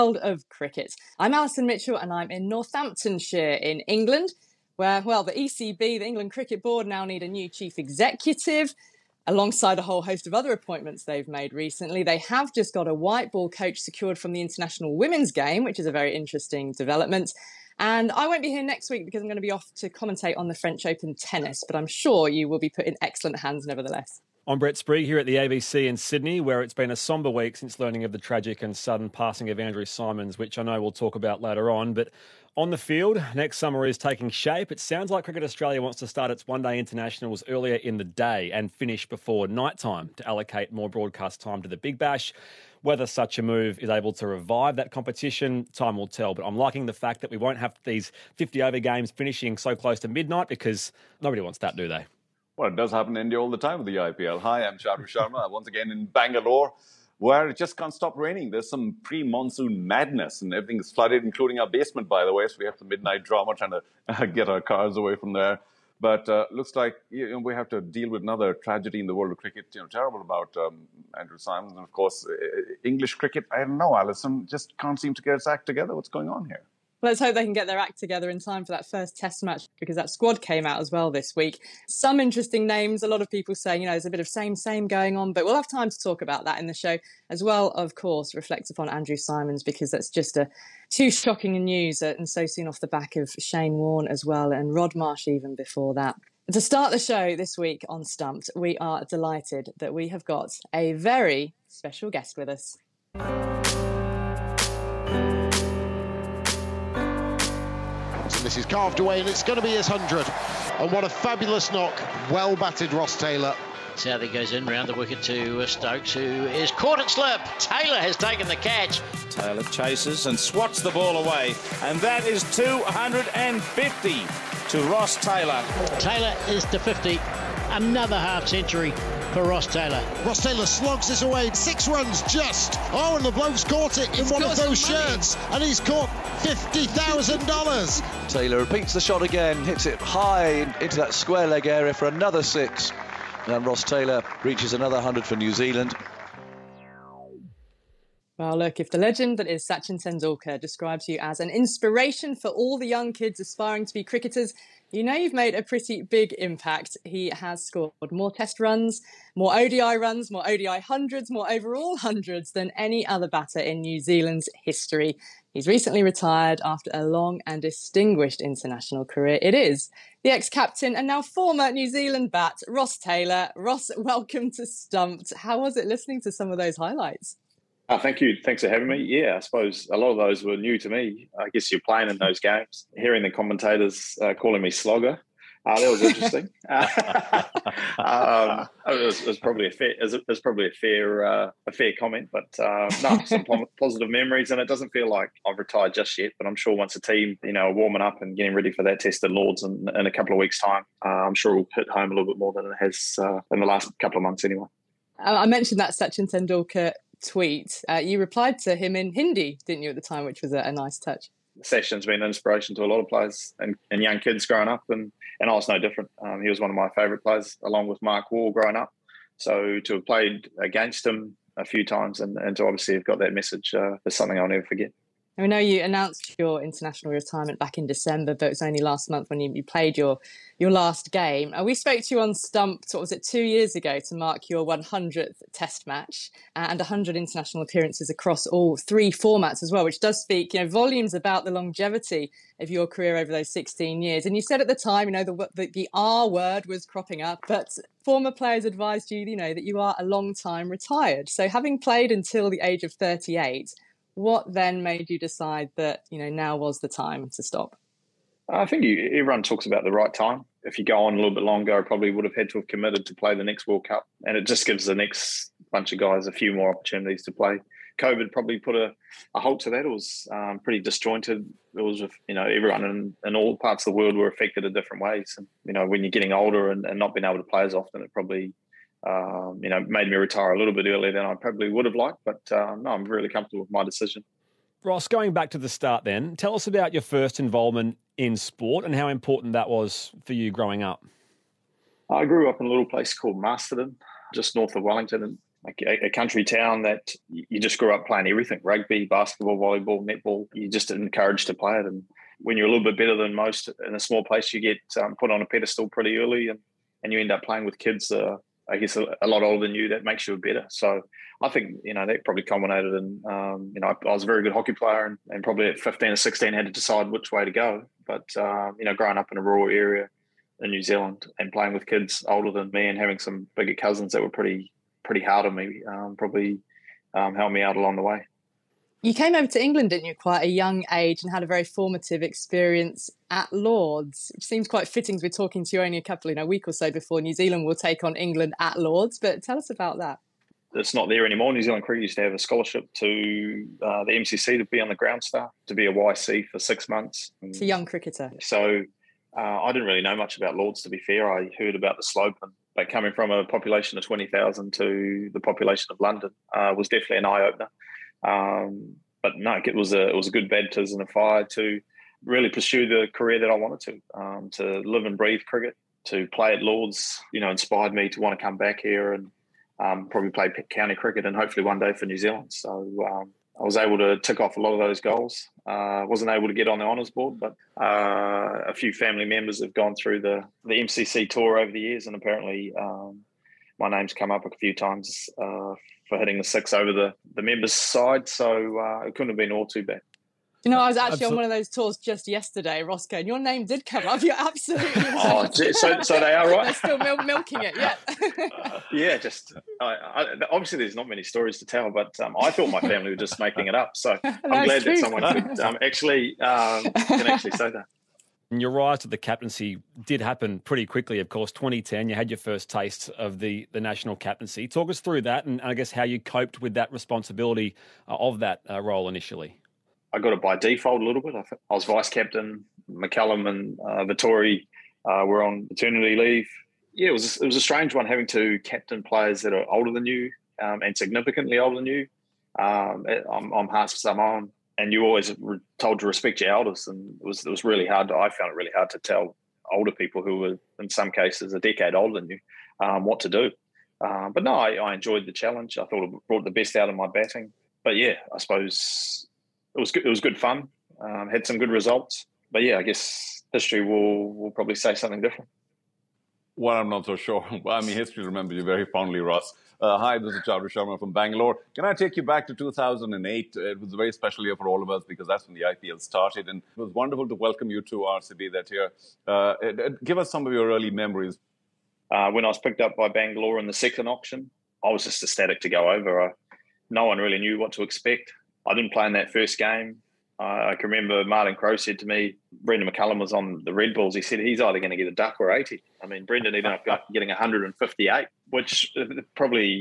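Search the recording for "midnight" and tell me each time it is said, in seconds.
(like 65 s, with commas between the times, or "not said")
50 s, 62 s.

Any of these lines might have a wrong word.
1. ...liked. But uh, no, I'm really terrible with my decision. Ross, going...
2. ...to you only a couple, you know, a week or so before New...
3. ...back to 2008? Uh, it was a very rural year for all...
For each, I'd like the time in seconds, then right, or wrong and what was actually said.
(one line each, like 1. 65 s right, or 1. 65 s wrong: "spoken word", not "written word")
1. 281 s wrong: "comfortable", not "terrible"
2. 335 s right
3. 462 s wrong: "special", not "rural".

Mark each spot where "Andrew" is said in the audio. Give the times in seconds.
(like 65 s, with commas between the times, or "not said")
29 s, 71 s, 88 s.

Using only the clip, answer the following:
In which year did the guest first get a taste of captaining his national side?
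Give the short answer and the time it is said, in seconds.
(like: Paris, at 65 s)
2010, at 411 s.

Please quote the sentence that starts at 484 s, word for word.
He said he's either going to get a duck or 80.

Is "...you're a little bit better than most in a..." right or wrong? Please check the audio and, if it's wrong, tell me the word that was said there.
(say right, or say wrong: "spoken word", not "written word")
right.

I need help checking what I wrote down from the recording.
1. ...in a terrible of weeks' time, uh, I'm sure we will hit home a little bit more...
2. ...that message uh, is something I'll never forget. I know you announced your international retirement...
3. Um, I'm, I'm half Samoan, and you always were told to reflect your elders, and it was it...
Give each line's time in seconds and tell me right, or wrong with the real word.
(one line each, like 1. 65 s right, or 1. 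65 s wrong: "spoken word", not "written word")
1. 199 s wrong: "couple", not "terrible"
2. 223 s right
3. 432 s wrong: "respect", not "reflect".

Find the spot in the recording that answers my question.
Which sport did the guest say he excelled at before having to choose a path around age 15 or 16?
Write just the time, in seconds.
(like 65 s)
314 s.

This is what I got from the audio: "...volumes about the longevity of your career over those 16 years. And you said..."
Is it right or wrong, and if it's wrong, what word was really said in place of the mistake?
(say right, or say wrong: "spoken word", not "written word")
right.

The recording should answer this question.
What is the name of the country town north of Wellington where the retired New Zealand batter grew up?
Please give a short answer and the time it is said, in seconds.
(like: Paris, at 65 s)
Masterton, at 293 s.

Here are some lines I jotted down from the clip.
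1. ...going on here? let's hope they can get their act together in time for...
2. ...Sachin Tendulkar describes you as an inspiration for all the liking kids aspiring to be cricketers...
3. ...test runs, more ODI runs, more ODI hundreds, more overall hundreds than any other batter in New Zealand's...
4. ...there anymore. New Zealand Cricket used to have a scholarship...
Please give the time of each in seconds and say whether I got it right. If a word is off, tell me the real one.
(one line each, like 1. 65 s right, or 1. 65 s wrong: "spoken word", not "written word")
1. 76 s right
2. 149 s wrong: "young", not "liking"
3. 158 s right
4. 341 s right.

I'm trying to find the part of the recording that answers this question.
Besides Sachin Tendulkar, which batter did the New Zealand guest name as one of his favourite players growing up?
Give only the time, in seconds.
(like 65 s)
218 s.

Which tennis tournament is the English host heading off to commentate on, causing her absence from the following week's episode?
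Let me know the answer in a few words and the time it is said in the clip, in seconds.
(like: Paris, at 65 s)
French Open, at 20 s.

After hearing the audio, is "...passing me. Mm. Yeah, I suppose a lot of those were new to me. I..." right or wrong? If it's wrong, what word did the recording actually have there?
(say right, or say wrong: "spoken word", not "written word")
wrong: "having", not "passing".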